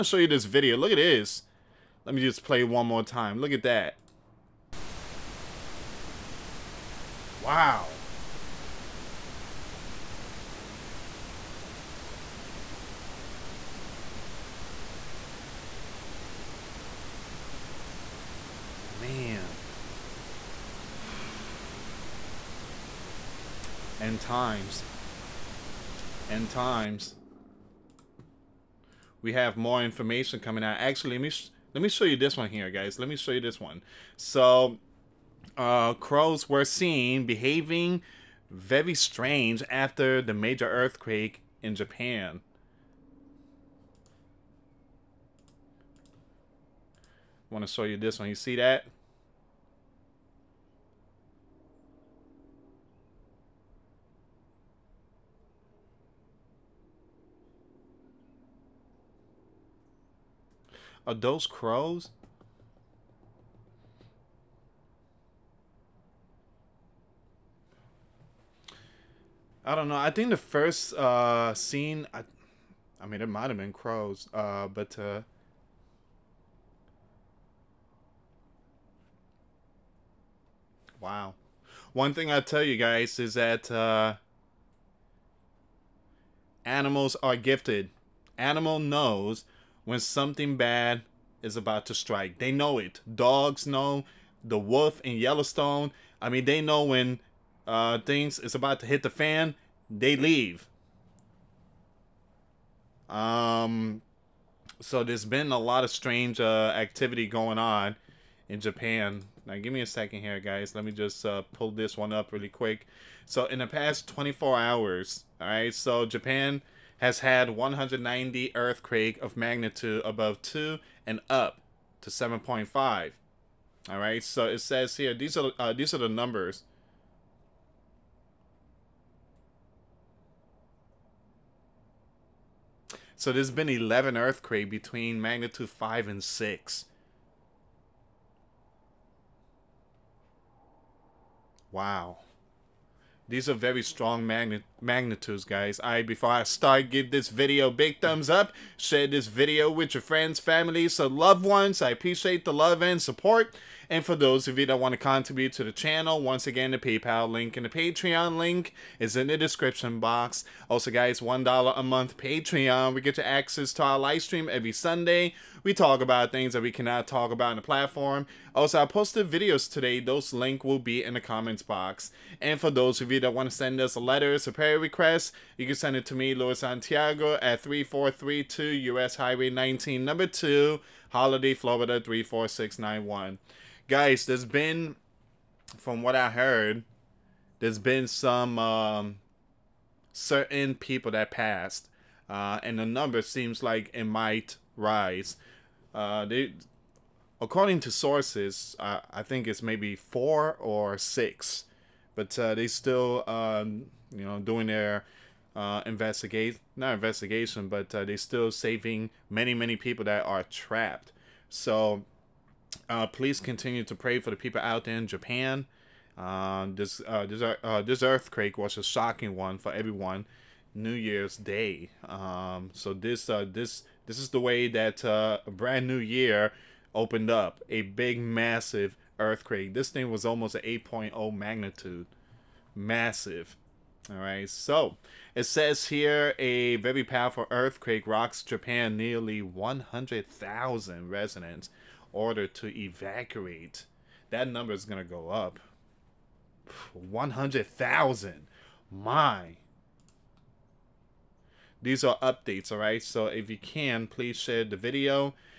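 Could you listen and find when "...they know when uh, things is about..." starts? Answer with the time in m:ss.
1:36.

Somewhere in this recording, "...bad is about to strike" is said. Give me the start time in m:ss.
1:30.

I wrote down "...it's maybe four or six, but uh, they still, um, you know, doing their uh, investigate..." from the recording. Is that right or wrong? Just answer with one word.
right.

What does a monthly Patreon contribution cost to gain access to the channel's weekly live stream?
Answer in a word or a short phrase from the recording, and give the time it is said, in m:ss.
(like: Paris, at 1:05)
$1, at 2:41.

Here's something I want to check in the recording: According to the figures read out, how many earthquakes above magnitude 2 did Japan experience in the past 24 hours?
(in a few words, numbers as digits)
190.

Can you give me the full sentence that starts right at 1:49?
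Now, give me a second here, guys.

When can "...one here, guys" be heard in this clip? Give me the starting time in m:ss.
0:32.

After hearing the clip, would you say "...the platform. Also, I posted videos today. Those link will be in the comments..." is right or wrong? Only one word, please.
right.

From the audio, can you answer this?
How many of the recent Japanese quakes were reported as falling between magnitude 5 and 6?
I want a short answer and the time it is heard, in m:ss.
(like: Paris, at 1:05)
11, at 2:13.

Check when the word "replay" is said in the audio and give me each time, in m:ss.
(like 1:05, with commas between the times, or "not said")
not said.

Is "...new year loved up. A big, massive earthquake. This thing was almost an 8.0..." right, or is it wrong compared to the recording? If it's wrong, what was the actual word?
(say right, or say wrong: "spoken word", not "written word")
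wrong: "opened", not "loved".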